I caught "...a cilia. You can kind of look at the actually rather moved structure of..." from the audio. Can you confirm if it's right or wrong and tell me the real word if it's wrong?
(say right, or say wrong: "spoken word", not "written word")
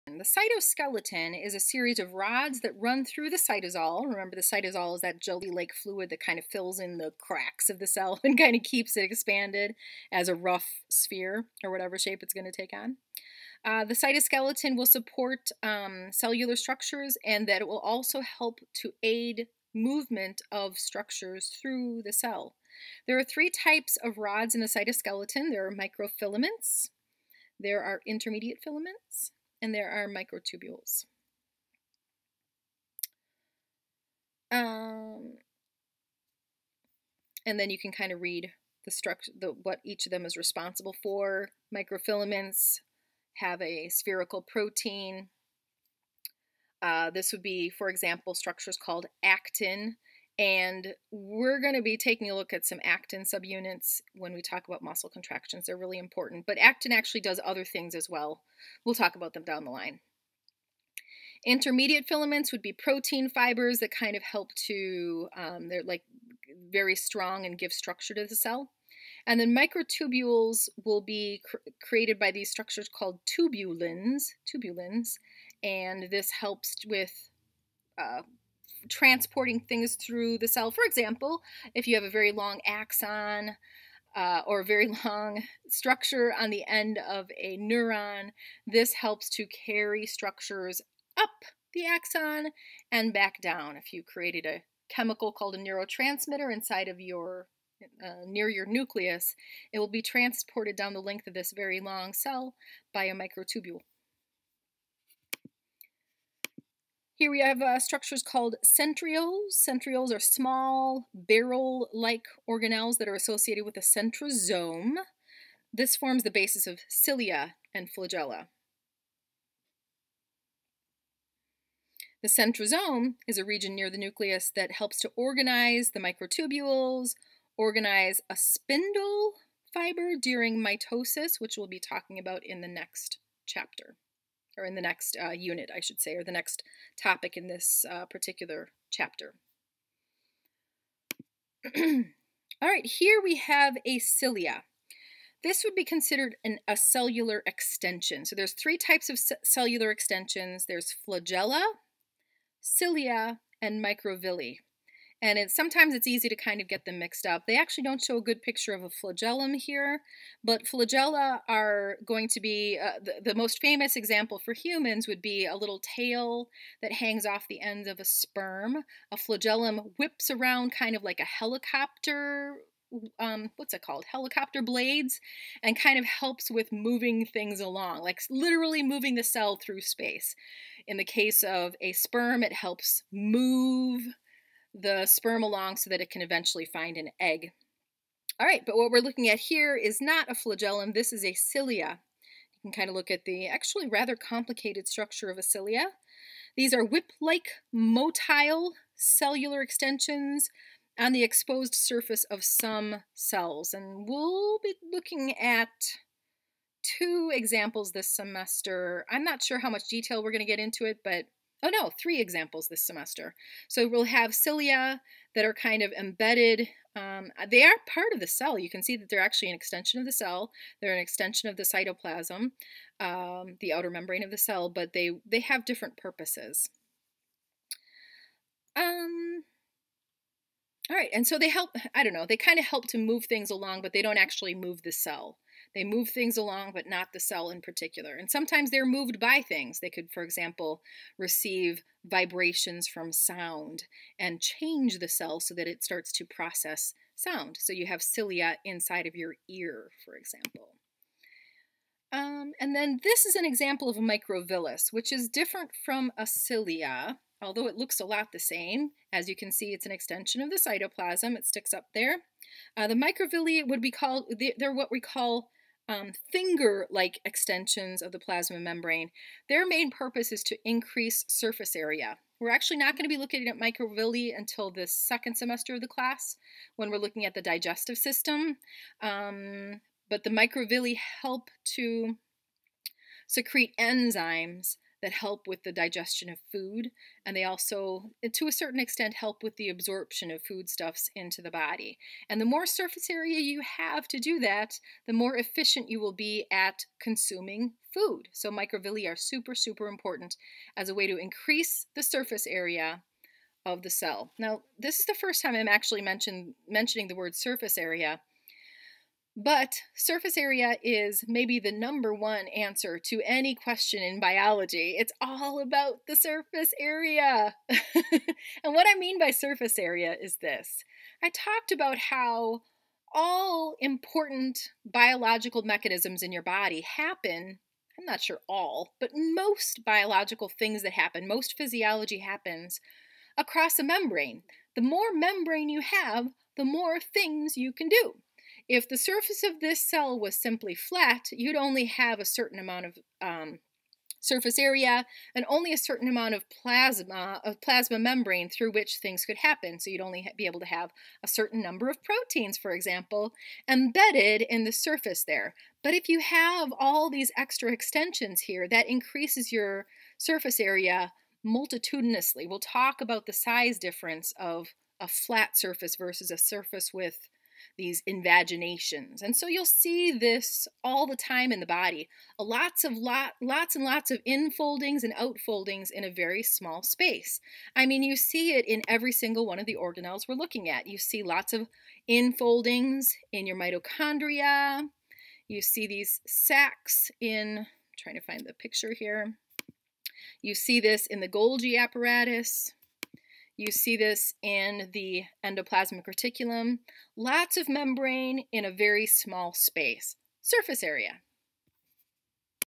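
wrong: "complicated", not "moved".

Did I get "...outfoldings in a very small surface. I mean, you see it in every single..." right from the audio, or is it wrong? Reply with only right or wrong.
wrong.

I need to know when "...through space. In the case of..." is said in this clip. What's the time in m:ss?
2:59.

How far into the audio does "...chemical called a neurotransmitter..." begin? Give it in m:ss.
1:34.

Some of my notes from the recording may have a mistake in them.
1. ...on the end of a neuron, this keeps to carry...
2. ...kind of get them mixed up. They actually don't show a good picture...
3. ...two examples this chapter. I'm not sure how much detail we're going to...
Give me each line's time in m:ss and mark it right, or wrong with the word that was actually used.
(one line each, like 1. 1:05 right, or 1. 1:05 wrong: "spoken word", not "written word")
1. 1:26 wrong: "helps", not "keeps"
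2. 2:36 right
3. 3:26 wrong: "semester", not "chapter".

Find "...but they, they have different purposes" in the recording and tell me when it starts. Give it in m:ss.
3:44.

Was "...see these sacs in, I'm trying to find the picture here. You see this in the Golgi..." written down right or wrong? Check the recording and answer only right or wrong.
right.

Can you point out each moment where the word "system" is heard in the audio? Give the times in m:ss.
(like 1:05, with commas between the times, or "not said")
4:37.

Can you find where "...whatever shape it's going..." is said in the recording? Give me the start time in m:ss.
0:11.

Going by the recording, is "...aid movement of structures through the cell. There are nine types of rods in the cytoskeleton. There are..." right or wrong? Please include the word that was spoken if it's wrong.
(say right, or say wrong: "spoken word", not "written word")
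wrong: "three", not "nine".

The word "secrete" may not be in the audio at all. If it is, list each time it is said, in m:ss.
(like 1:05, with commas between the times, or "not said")
4:43.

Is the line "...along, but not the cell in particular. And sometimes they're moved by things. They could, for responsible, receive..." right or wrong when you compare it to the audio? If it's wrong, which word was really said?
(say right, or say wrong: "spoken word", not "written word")
wrong: "example", not "responsible".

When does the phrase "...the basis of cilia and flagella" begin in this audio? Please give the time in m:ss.
1:56.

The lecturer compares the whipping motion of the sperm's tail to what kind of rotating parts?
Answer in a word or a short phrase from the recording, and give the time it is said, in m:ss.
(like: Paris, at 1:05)
helicopter blades, at 2:54.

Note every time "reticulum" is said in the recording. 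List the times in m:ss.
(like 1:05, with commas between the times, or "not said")
6:36.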